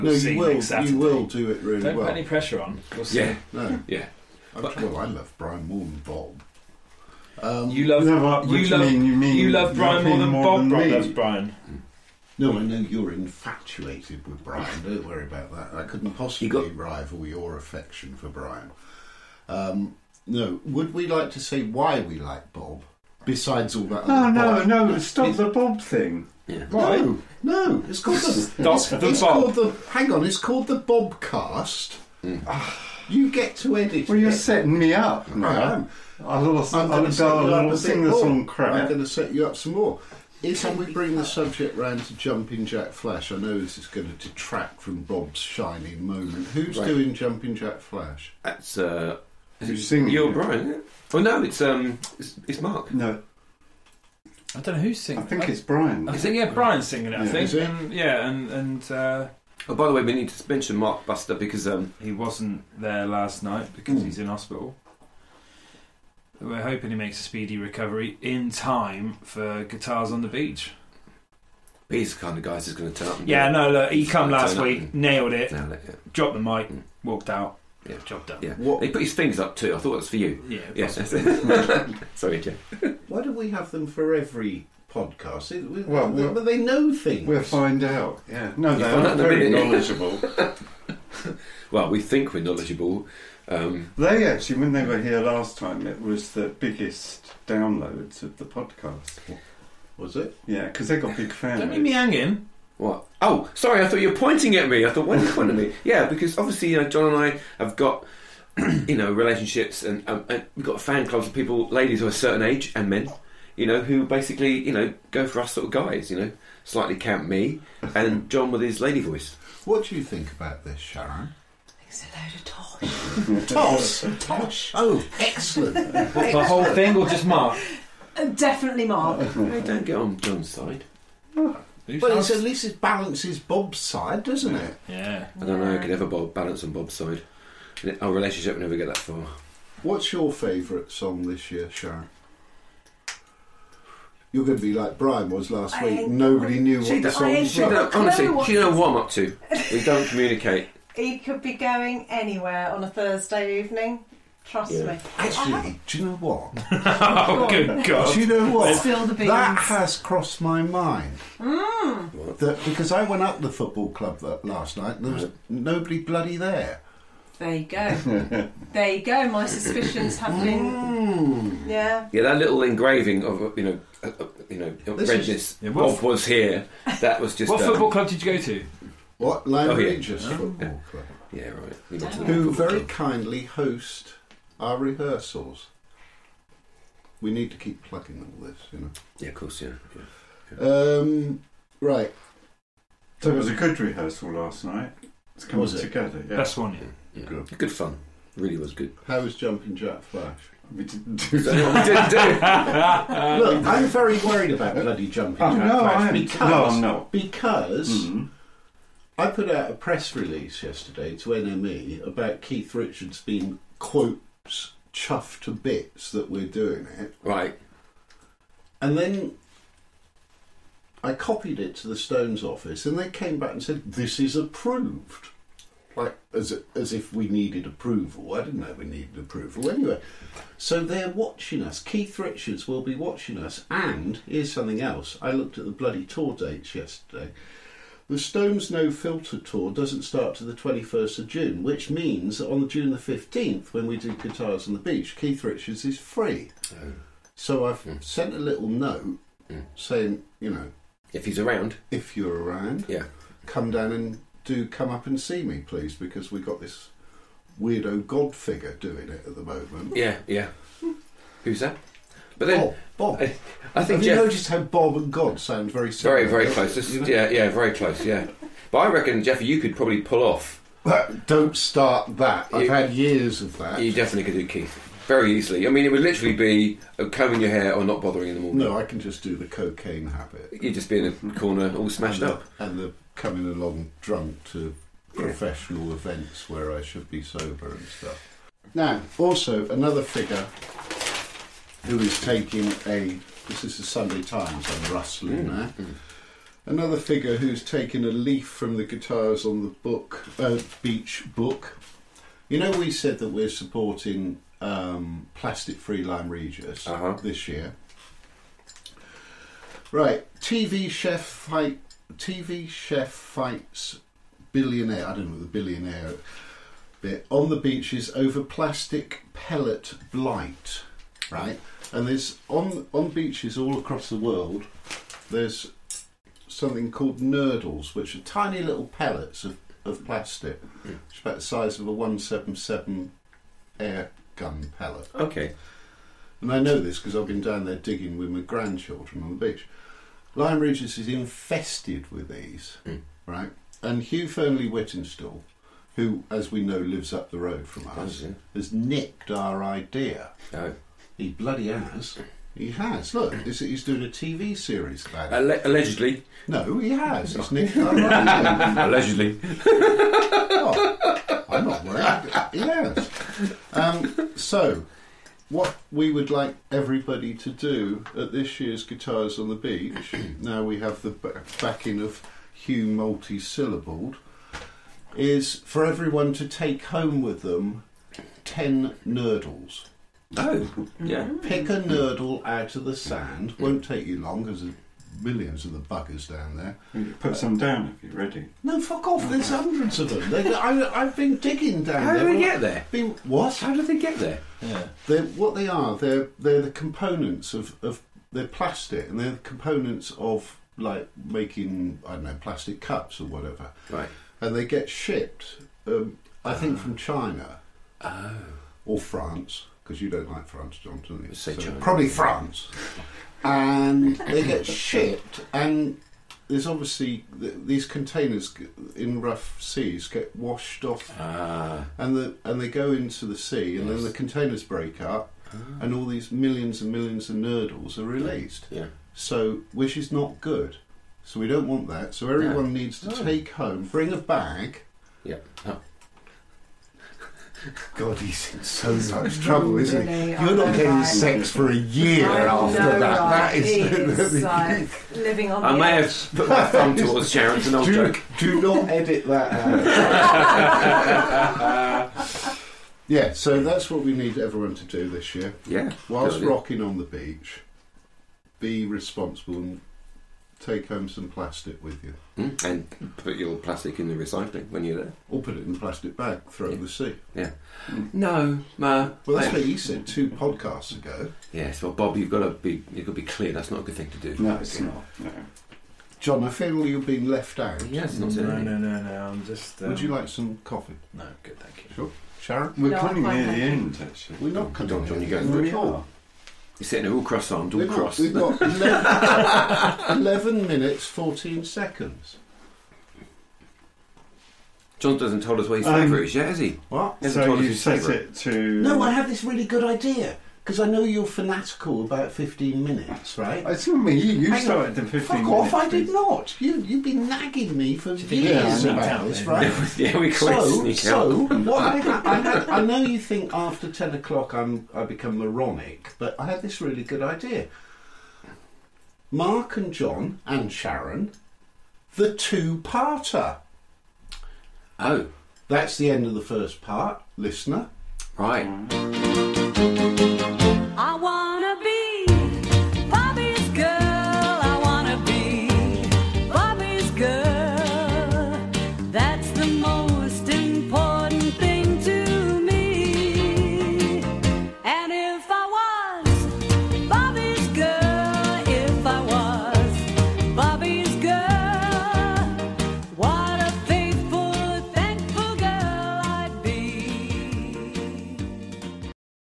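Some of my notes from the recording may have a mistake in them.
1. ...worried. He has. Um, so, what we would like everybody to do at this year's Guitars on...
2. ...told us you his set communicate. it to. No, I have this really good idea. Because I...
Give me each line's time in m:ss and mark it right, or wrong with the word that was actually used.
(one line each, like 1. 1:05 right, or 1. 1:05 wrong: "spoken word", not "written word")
1. 6:01 right
2. 8:17 wrong: "favourite", not "communicate".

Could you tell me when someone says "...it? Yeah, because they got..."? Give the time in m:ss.
1:40.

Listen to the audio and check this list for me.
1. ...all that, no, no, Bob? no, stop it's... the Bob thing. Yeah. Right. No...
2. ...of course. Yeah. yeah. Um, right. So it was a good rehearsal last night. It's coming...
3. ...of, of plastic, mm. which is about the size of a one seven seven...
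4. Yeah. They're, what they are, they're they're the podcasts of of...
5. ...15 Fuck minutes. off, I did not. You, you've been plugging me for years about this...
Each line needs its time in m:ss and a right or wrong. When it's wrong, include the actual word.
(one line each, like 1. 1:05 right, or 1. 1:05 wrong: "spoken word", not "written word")
1. 0:23 right
2. 3:09 right
3. 5:29 right
4. 6:34 wrong: "components", not "podcasts"
5. 8:25 wrong: "nagging", not "plugging".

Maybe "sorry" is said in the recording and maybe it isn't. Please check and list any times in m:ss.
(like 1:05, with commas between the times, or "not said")
1:22, 1:43.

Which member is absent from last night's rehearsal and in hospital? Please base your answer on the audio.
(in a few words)
Mark Buster.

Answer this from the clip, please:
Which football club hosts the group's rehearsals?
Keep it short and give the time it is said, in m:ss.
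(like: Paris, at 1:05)
Regis Football Club, at 2:59.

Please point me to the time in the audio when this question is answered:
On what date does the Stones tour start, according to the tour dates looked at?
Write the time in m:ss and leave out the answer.
4:00.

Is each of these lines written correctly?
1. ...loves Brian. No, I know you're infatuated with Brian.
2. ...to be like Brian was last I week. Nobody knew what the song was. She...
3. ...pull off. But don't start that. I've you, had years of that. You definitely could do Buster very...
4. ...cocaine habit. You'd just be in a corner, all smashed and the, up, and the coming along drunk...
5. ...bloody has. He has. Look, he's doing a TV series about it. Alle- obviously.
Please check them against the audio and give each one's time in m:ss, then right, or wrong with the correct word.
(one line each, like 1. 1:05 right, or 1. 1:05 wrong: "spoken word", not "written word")
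1. 0:10 right
2. 2:24 right
3. 4:30 wrong: "Keith", not "Buster"
4. 4:39 right
5. 5:51 wrong: "allegedly", not "obviously".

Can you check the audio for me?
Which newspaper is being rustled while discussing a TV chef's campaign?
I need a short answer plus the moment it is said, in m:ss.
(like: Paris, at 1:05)
The Sunday Times, at 4:53.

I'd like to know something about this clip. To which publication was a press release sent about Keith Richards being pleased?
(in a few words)
NME.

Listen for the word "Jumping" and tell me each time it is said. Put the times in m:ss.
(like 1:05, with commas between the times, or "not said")
0:42, 0:47, 3:19, 3:25.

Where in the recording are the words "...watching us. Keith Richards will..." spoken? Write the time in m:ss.
3:51.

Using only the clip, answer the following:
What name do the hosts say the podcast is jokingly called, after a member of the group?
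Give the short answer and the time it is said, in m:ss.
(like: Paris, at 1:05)
The Bobcast, at 0:30.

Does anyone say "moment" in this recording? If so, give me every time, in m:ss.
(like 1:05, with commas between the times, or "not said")
0:46, 4:19.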